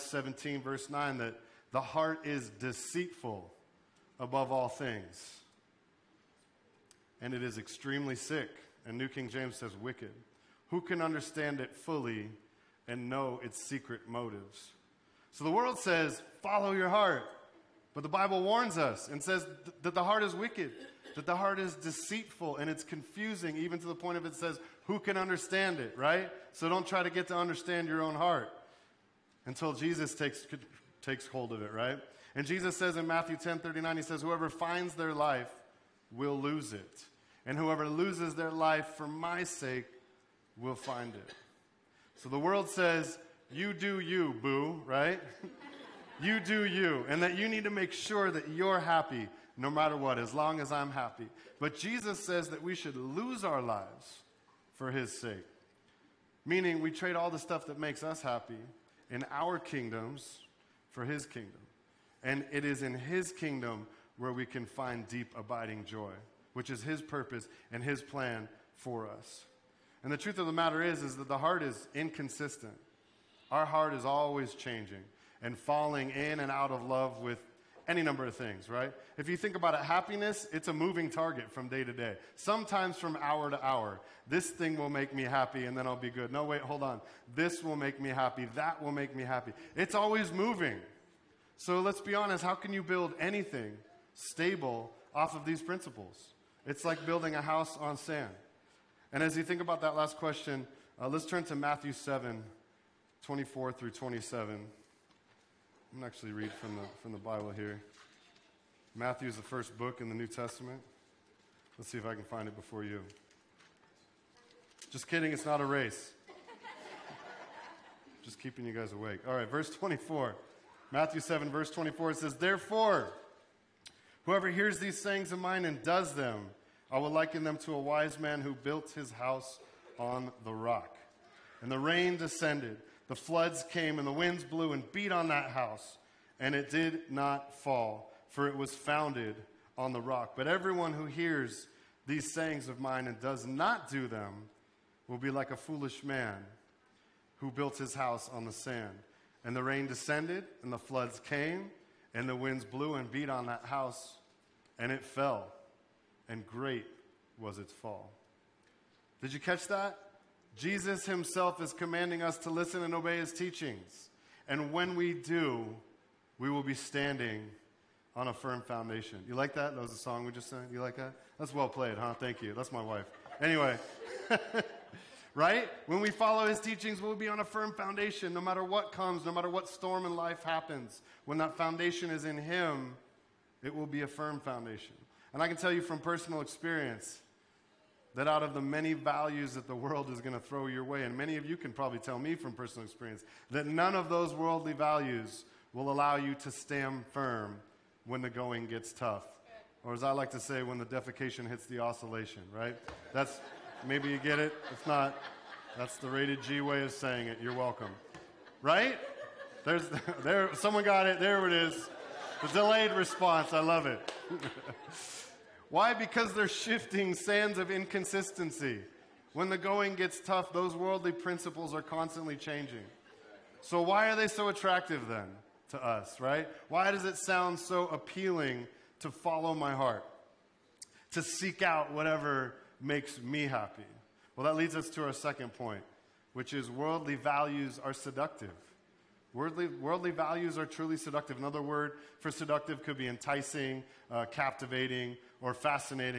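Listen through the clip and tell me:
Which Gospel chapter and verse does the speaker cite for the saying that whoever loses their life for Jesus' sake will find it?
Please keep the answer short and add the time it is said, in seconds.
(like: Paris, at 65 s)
Matthew 10:39, at 33 s.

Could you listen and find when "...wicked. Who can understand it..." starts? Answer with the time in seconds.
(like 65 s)
9 s.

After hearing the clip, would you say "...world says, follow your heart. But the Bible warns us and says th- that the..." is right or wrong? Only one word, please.
right.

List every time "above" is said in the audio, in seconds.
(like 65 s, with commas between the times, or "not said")
4 s.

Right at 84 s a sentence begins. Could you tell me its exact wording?
This thing will make me happy and then I'll be good.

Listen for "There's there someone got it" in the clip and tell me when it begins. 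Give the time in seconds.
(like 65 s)
209 s.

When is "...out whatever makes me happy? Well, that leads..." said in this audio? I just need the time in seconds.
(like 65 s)
231 s.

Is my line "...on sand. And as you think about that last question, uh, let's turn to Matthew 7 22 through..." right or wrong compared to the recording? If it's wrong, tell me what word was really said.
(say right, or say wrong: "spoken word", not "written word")
wrong: "24", not "22".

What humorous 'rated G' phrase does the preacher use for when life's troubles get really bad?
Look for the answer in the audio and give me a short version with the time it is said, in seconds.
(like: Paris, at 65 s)
When the defecation hits the oscillation, at 200 s.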